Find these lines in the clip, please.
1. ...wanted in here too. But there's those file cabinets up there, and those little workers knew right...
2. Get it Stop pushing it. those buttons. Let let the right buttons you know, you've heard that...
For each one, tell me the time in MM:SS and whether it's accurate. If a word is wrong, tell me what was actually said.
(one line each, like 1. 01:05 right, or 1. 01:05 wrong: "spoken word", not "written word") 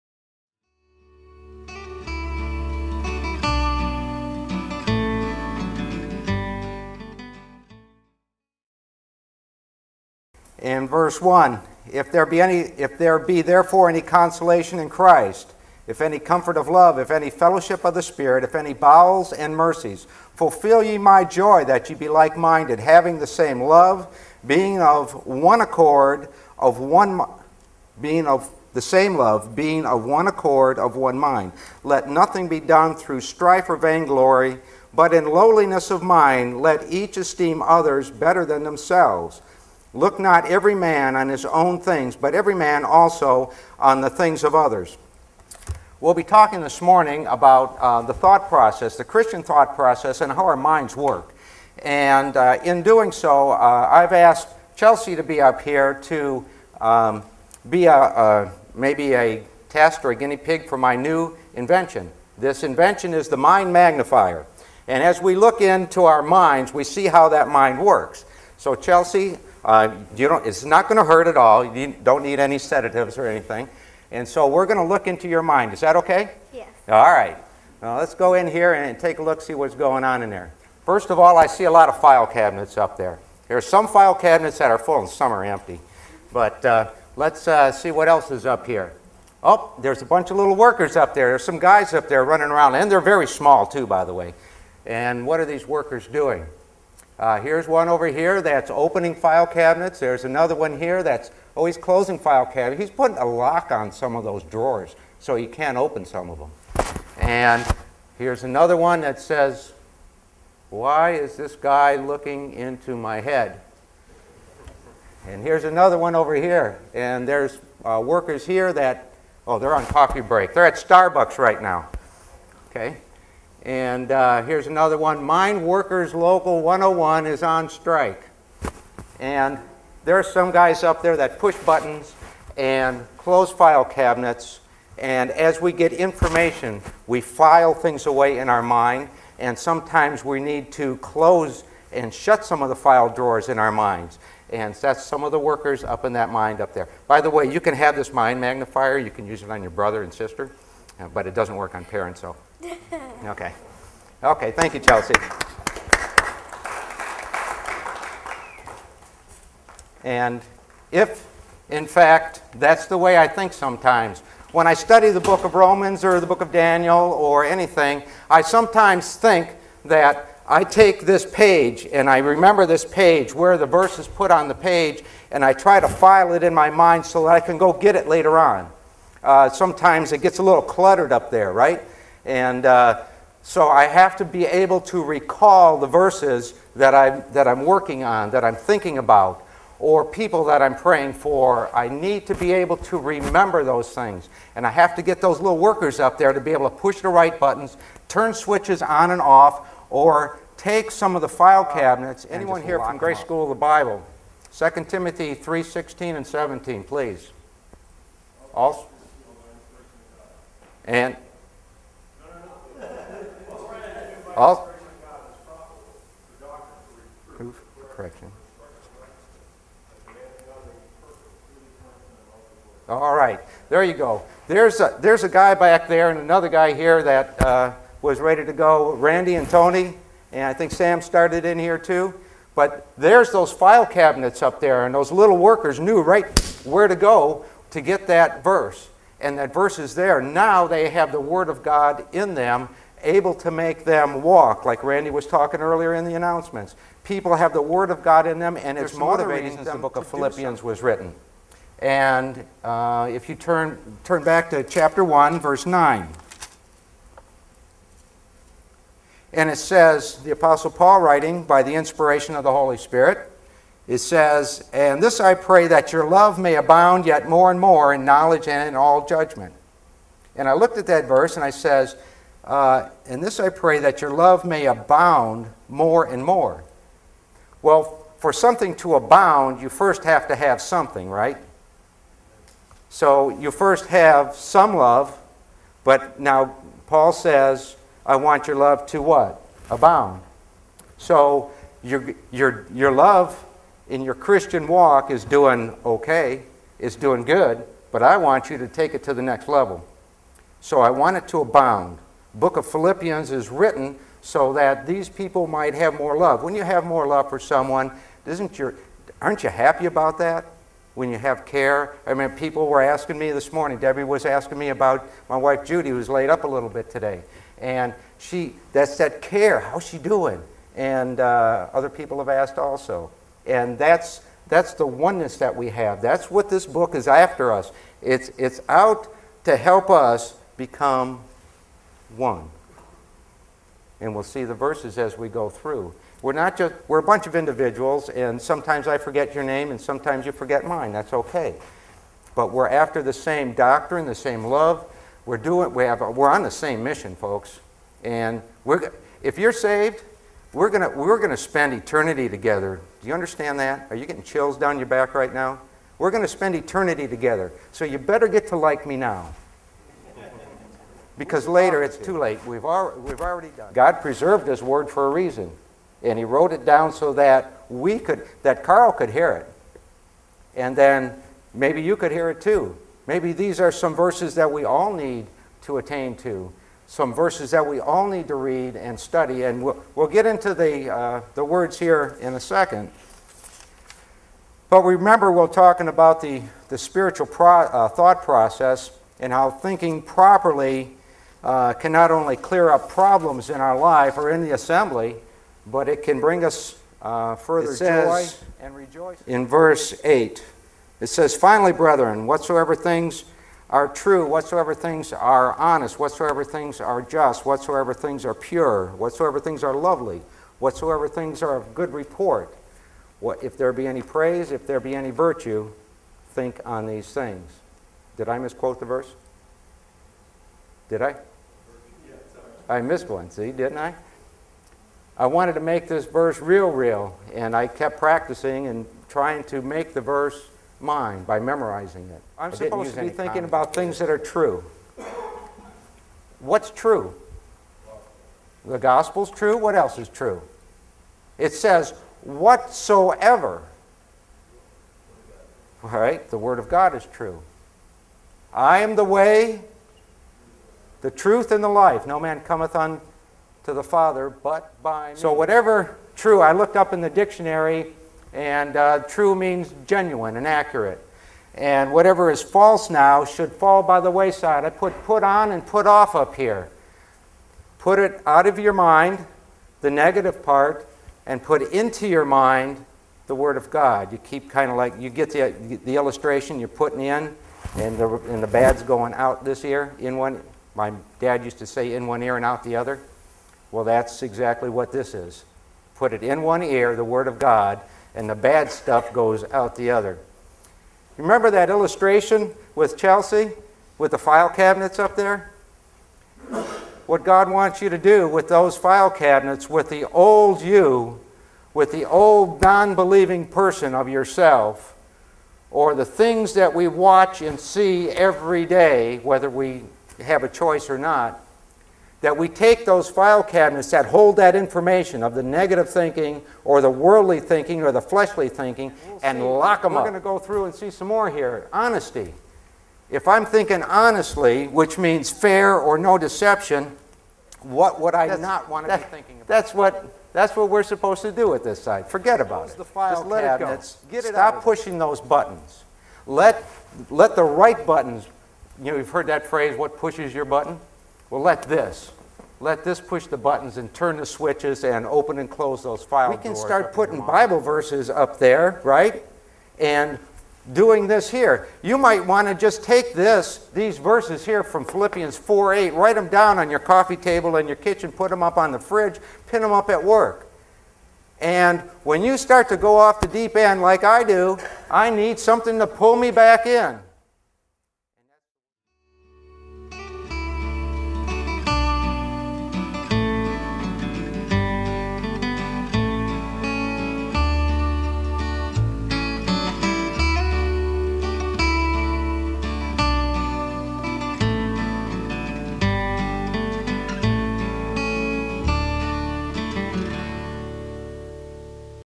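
1. 03:51 wrong: "started", not "wanted"
2. 08:54 right.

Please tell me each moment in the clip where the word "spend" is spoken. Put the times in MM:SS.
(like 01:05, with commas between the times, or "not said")
05:51, 05:56.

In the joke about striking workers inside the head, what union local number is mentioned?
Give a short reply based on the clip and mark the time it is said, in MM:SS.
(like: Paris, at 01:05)
101, at 02:05.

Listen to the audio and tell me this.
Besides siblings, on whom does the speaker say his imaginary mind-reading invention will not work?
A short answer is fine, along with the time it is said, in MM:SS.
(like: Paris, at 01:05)
Parents, at 02:31.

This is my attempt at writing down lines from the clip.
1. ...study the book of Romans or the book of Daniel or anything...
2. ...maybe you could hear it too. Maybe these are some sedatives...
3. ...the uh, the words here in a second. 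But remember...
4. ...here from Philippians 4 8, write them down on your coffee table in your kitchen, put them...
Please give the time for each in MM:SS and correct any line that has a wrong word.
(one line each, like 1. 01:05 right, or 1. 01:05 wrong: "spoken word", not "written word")
1. 02:44 right
2. 06:11 wrong: "verses", not "sedatives"
3. 06:20 right
4. 09:14 right.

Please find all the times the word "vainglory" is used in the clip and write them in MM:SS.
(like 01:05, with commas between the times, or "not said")
00:33.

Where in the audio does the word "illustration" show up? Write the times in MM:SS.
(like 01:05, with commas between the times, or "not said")
07:55, 08:11.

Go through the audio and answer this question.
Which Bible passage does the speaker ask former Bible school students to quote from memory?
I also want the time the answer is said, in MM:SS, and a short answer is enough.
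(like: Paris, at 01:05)
2 Timothy 3:16-17, at 03:24.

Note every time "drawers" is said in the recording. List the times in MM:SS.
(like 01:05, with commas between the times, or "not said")
01:44, 02:23.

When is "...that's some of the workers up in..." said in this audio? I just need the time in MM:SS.
02:24.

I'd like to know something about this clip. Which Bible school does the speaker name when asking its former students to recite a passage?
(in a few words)
Grace School of the Bible.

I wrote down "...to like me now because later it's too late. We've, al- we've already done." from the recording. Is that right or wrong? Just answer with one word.
right.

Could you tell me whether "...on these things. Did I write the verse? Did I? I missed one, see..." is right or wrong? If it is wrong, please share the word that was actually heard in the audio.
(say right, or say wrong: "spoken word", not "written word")
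wrong: "misquote", not "write".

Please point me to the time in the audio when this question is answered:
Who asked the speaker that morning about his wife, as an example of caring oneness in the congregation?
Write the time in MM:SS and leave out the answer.
05:13.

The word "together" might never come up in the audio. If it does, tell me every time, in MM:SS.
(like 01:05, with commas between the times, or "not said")
05:52, 05:57.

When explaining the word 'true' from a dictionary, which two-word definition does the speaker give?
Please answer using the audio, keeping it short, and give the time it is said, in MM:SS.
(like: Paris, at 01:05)
genuine and accurate, at 07:39.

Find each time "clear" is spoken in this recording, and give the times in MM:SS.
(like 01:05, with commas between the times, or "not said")
06:32.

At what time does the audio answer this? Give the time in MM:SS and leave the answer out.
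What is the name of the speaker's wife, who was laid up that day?
05:15.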